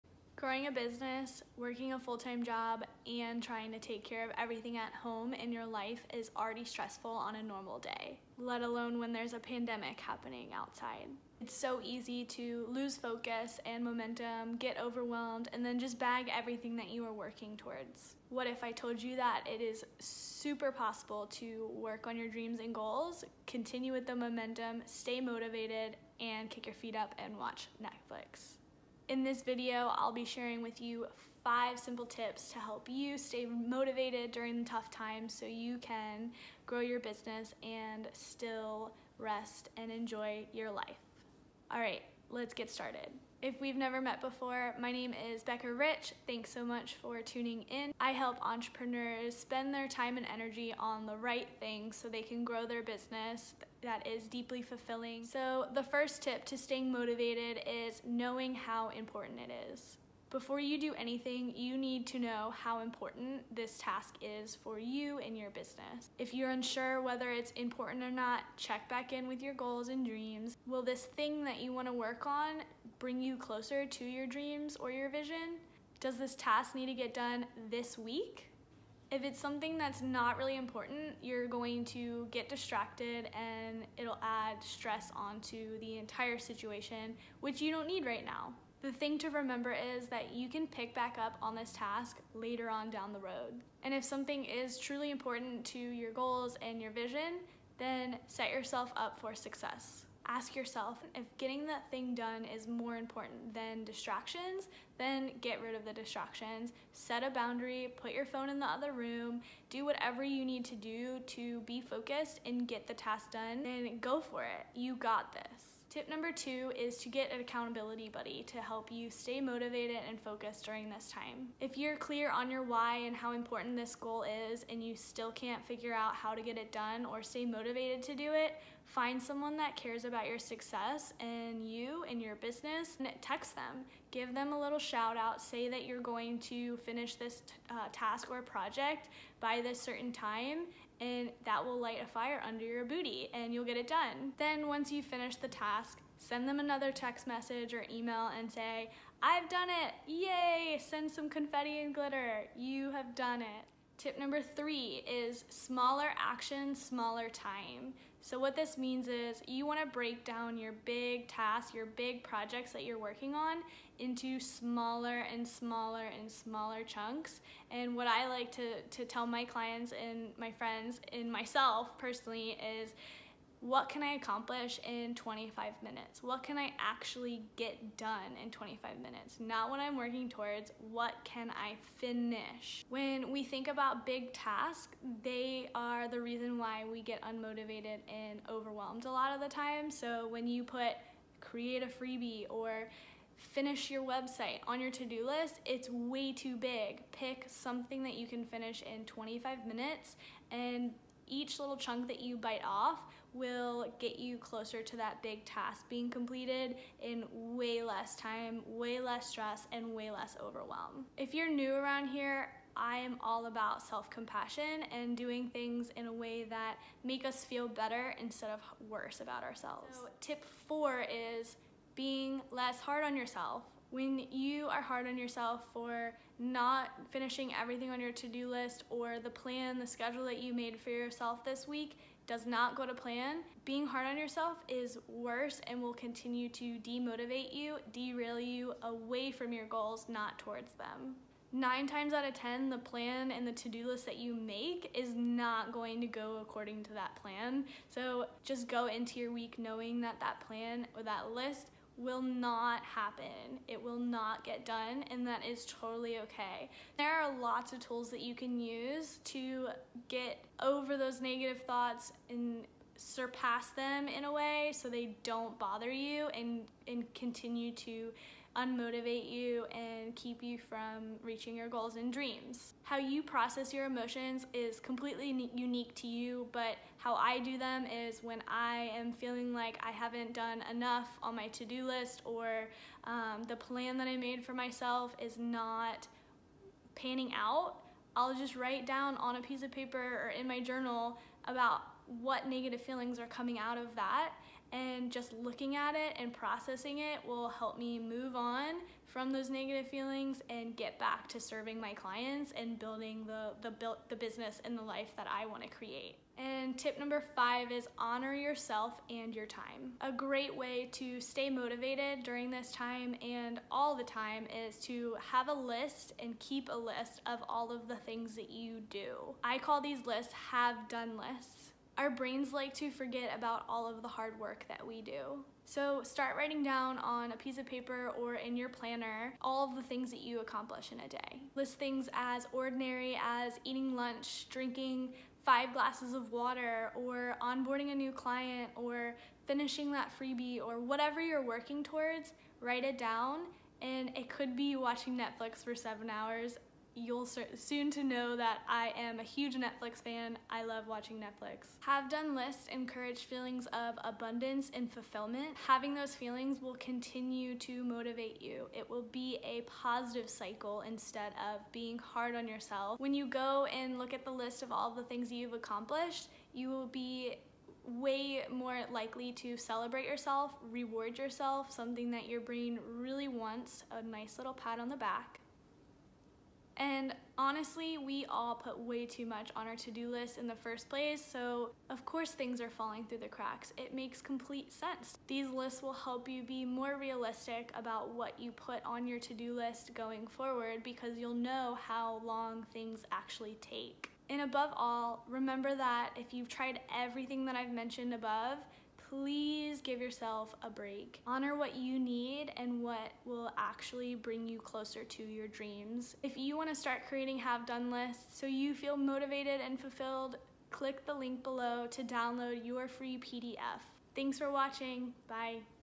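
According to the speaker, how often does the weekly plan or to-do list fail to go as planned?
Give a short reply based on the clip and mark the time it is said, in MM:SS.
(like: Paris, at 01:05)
9 times out of 10, at 04:01.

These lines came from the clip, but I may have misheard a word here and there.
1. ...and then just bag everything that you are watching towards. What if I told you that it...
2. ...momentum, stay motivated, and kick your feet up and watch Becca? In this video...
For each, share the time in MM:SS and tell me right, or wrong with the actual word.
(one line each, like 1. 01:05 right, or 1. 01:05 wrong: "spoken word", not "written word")
1. 00:15 wrong: "working", not "watching"
2. 00:24 wrong: "Netflix", not "Becca".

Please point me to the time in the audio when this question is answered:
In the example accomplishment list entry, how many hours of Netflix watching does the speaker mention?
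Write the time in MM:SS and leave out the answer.
05:45.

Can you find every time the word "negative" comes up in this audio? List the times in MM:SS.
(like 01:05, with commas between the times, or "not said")
04:21, 04:52, 04:59.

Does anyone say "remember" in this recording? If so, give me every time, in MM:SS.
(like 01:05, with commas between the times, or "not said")
01:29, 06:35.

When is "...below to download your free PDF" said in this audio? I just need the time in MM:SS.
06:51.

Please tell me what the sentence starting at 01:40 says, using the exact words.
Ask yourself if getting that thing done is more important than distractions, then get rid of the distractions.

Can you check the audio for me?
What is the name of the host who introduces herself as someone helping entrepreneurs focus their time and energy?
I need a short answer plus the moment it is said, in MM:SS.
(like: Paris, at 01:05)
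Becca Rich, at 00:45.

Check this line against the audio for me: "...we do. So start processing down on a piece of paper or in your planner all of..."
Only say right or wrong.
wrong.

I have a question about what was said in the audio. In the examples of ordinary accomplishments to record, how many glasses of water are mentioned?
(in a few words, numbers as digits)
5.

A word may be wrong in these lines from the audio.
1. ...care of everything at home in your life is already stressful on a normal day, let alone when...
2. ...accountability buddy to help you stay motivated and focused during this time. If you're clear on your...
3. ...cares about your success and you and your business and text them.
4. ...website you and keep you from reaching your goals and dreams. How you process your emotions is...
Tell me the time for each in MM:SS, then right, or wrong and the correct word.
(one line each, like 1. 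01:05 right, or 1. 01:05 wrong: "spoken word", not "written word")
1. 00:04 right
2. 01:57 right
3. 02:09 right
4. 04:28 wrong: "unmotivate", not "website".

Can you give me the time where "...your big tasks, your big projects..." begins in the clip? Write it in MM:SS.
02:40.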